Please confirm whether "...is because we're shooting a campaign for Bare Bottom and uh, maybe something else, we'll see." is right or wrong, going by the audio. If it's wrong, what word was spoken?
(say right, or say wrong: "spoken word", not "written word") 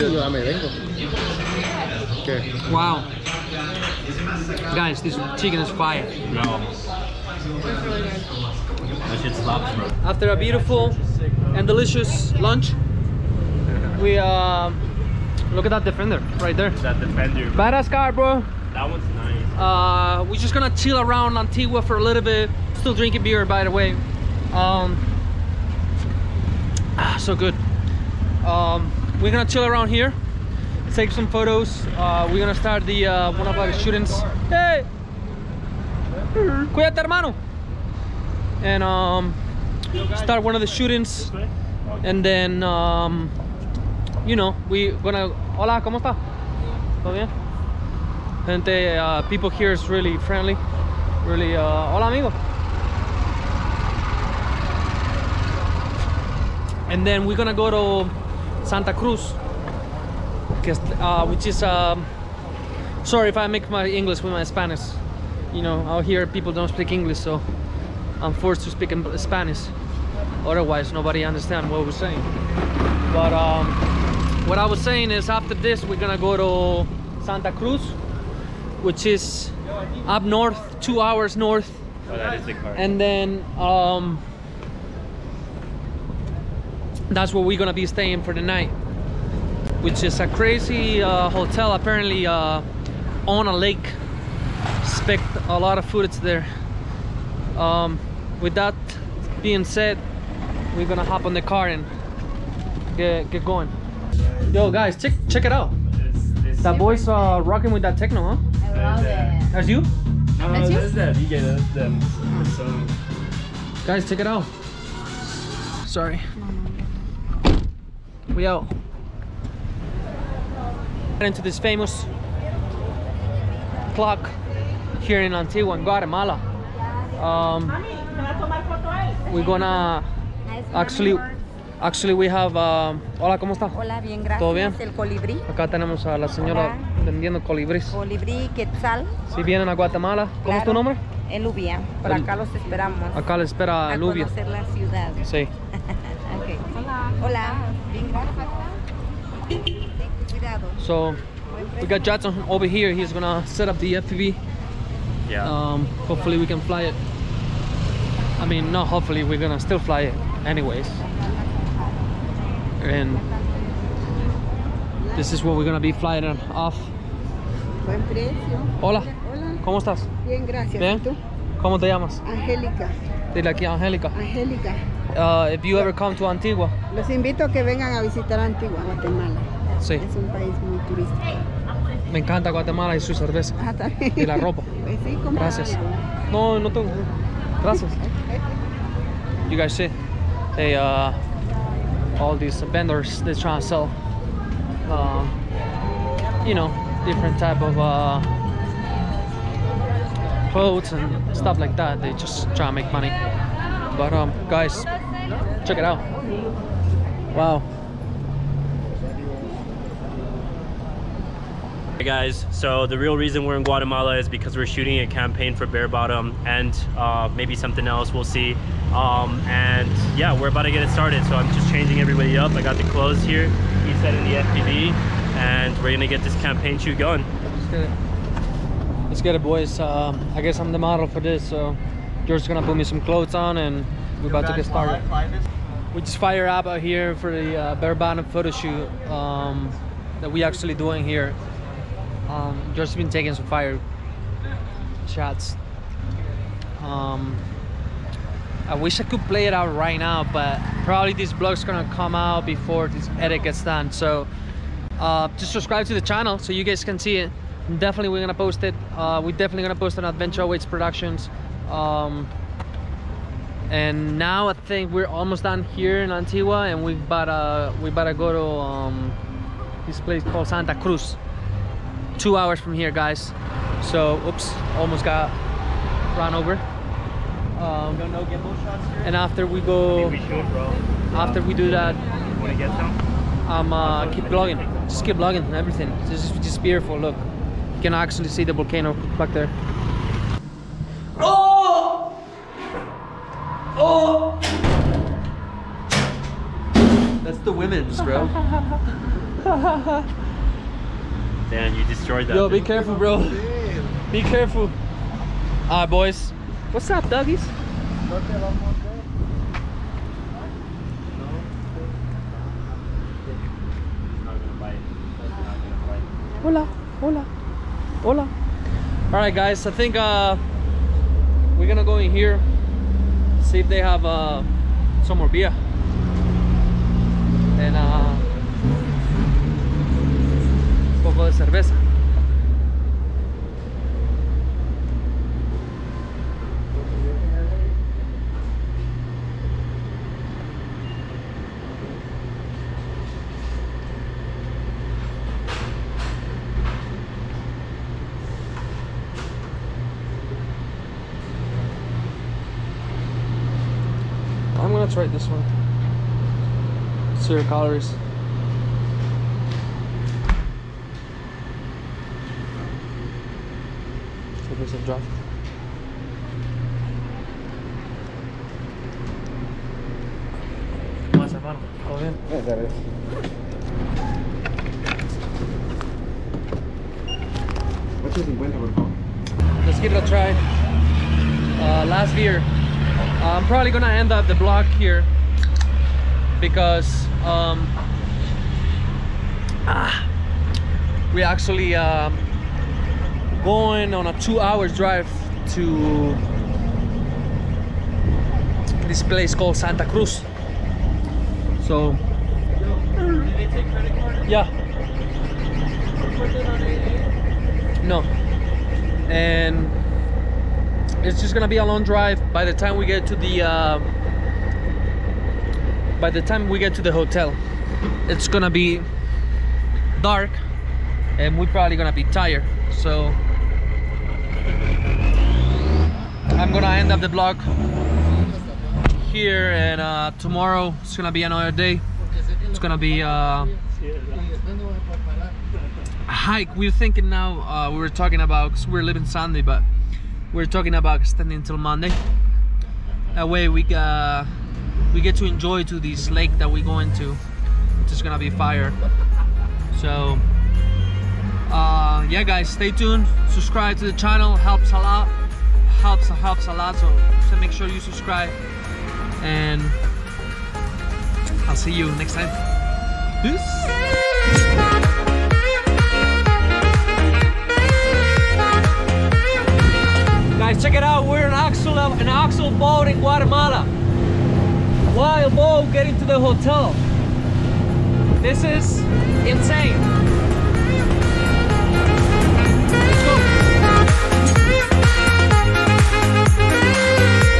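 right.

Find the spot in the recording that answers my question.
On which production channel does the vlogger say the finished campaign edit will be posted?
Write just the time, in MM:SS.
04:20.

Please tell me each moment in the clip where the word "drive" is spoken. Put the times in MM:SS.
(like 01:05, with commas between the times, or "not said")
06:34, 06:51.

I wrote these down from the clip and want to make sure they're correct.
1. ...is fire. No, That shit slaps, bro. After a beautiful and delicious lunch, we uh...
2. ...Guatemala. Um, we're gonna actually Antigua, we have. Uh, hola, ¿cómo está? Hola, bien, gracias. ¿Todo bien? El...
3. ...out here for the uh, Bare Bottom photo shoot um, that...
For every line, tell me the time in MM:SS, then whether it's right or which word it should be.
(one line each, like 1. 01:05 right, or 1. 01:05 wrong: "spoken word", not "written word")
1. 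00:05 right
2. 02:05 wrong: "Actually", not "Antigua"
3. 03:56 right.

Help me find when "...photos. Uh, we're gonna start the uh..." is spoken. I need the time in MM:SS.
00:31.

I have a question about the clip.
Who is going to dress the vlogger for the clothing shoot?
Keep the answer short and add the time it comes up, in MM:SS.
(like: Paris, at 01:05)
George, at 03:52.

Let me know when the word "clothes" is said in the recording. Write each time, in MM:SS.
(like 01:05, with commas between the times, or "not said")
03:20, 03:42, 03:53.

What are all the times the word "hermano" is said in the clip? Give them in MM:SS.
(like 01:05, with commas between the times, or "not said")
00:37, 06:11.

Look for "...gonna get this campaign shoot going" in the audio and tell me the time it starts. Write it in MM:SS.
03:45.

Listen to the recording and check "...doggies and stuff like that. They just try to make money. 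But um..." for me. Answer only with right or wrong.
wrong.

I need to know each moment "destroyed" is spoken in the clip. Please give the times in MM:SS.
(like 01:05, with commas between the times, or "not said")
05:01.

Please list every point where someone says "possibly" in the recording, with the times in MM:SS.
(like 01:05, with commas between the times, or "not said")
not said.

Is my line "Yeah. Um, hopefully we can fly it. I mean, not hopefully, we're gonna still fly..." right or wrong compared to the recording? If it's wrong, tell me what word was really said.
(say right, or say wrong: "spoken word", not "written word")
right.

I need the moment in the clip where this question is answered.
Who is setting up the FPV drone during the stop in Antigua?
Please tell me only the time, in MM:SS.
02:32.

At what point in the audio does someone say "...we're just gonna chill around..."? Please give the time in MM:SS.
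00:20.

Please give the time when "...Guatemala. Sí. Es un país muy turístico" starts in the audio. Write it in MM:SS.
02:58.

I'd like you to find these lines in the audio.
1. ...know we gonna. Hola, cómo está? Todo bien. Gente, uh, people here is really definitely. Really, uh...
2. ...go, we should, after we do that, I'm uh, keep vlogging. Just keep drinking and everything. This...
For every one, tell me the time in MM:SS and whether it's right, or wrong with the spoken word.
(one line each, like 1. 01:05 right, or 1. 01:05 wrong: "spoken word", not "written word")
1. 00:44 wrong: "friendly", not "definitely"
2. 04:39 wrong: "vlogging", not "drinking".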